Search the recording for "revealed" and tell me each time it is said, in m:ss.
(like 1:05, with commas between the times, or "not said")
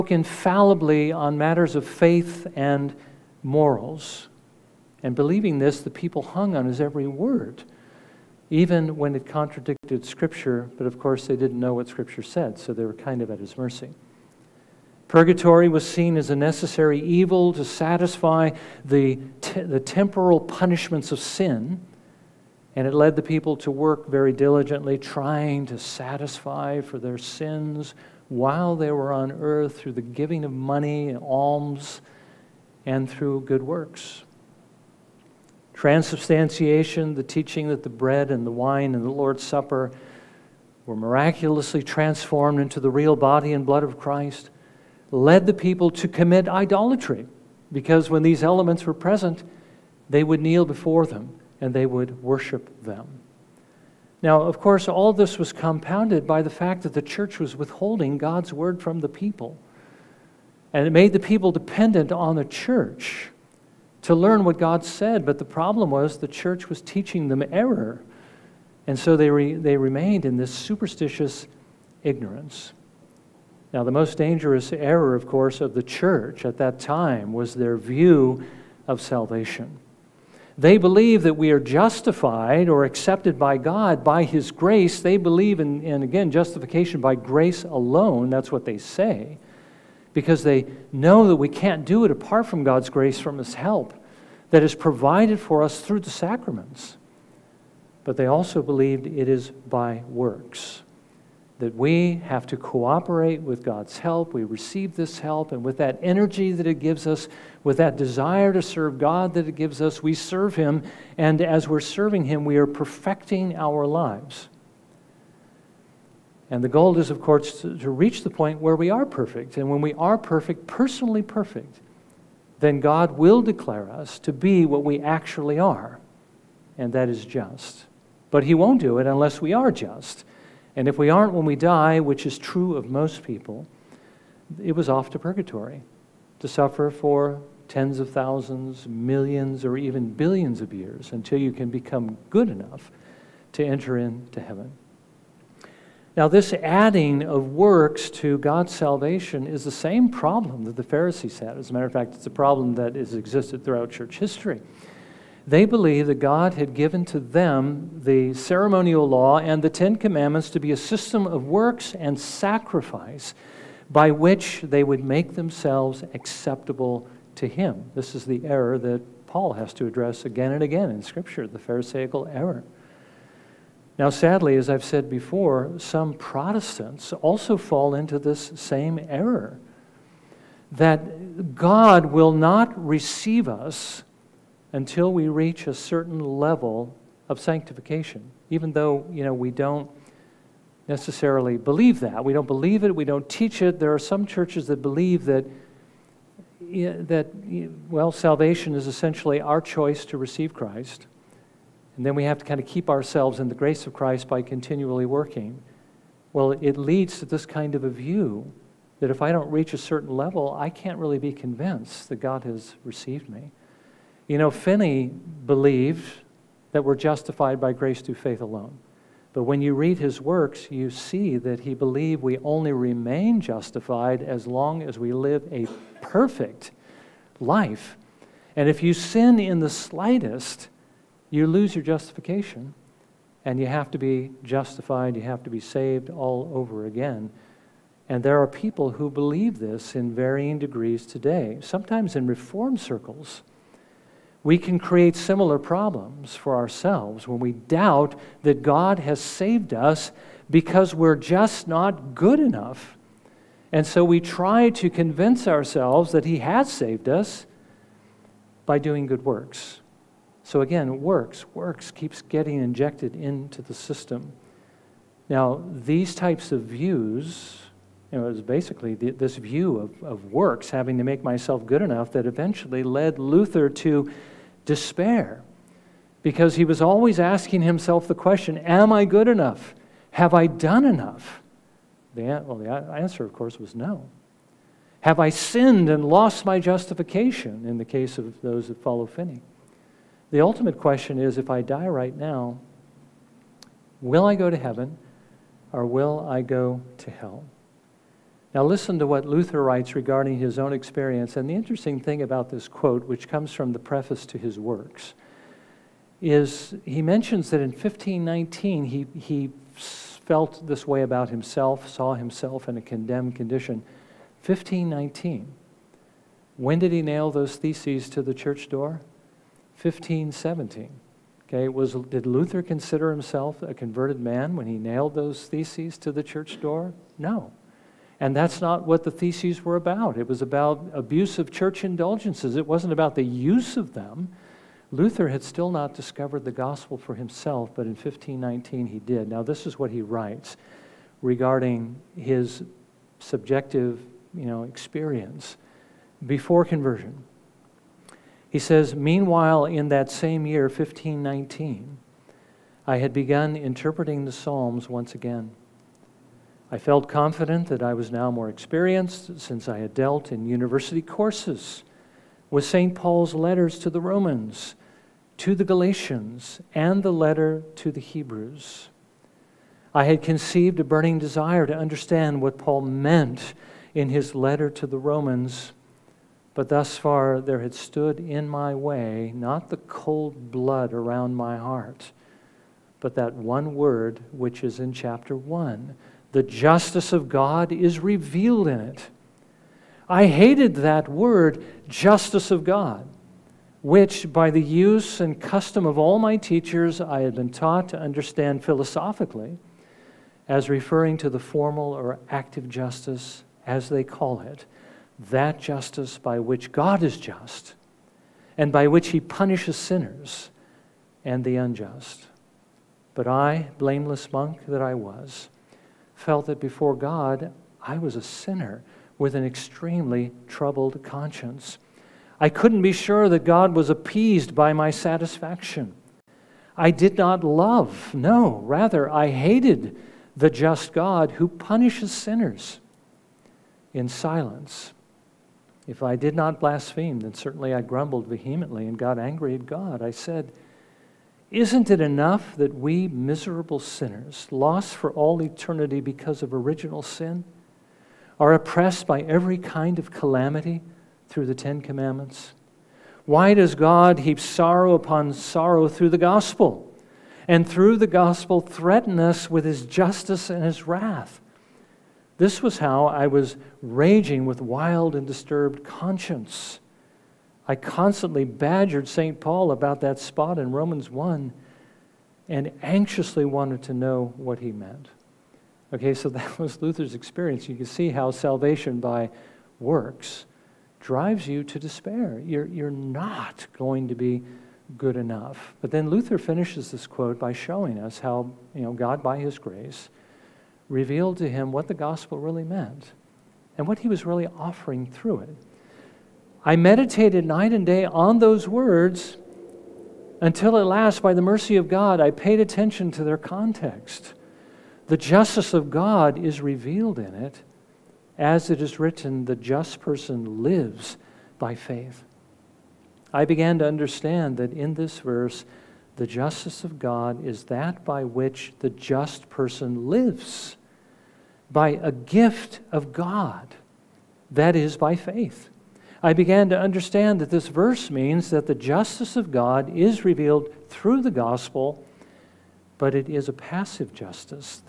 6:27, 8:10, 8:26, 8:50.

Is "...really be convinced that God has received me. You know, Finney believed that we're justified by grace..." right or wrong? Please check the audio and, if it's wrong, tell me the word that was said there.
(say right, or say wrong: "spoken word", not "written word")
right.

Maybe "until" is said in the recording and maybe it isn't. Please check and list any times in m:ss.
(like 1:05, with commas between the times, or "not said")
2:21, 3:04, 8:20.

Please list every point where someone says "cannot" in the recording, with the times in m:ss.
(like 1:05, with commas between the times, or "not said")
not said.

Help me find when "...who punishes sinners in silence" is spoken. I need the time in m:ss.
7:11.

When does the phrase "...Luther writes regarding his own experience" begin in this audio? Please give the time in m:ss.
4:59.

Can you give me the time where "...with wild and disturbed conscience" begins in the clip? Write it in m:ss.
7:44.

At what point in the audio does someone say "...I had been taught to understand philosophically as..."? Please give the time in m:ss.
6:37.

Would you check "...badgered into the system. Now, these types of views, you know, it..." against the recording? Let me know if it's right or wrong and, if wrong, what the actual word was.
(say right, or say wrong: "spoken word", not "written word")
wrong: "injected", not "badgered".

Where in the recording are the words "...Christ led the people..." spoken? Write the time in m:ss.
0:43.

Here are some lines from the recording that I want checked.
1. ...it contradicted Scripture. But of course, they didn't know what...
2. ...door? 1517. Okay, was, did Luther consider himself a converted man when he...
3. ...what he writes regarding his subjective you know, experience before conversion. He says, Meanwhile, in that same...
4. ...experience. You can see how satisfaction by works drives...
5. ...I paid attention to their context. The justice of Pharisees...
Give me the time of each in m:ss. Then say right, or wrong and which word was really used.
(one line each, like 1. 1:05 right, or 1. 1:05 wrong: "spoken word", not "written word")
1. 0:09 right
2. 5:18 right
3. 5:39 right
4. 7:57 wrong: "salvation", not "satisfaction"
5. 8:22 wrong: "God", not "Pharisees".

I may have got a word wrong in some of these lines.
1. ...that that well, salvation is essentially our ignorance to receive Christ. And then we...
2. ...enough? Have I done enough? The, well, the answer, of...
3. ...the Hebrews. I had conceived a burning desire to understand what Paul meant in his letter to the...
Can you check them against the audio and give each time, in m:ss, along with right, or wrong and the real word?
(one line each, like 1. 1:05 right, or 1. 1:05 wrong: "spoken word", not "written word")
1. 3:15 wrong: "choice", not "ignorance"
2. 4:39 right
3. 6:07 right.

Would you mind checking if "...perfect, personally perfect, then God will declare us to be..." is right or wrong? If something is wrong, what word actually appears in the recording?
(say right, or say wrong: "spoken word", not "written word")
right.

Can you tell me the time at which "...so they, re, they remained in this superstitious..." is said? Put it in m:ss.
1:08.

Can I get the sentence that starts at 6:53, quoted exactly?
But I, blameless monk that I was, felt that before God, I was a sinner with an extremely troubled conscience.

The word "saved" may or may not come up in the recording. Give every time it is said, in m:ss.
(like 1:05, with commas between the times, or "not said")
3:55, 4:09, 4:16.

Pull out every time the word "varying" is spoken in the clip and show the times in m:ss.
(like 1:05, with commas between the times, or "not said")
4:00.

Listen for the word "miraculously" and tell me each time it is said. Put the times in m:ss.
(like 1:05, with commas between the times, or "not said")
0:40.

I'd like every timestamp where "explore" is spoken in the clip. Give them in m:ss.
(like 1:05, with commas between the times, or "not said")
not said.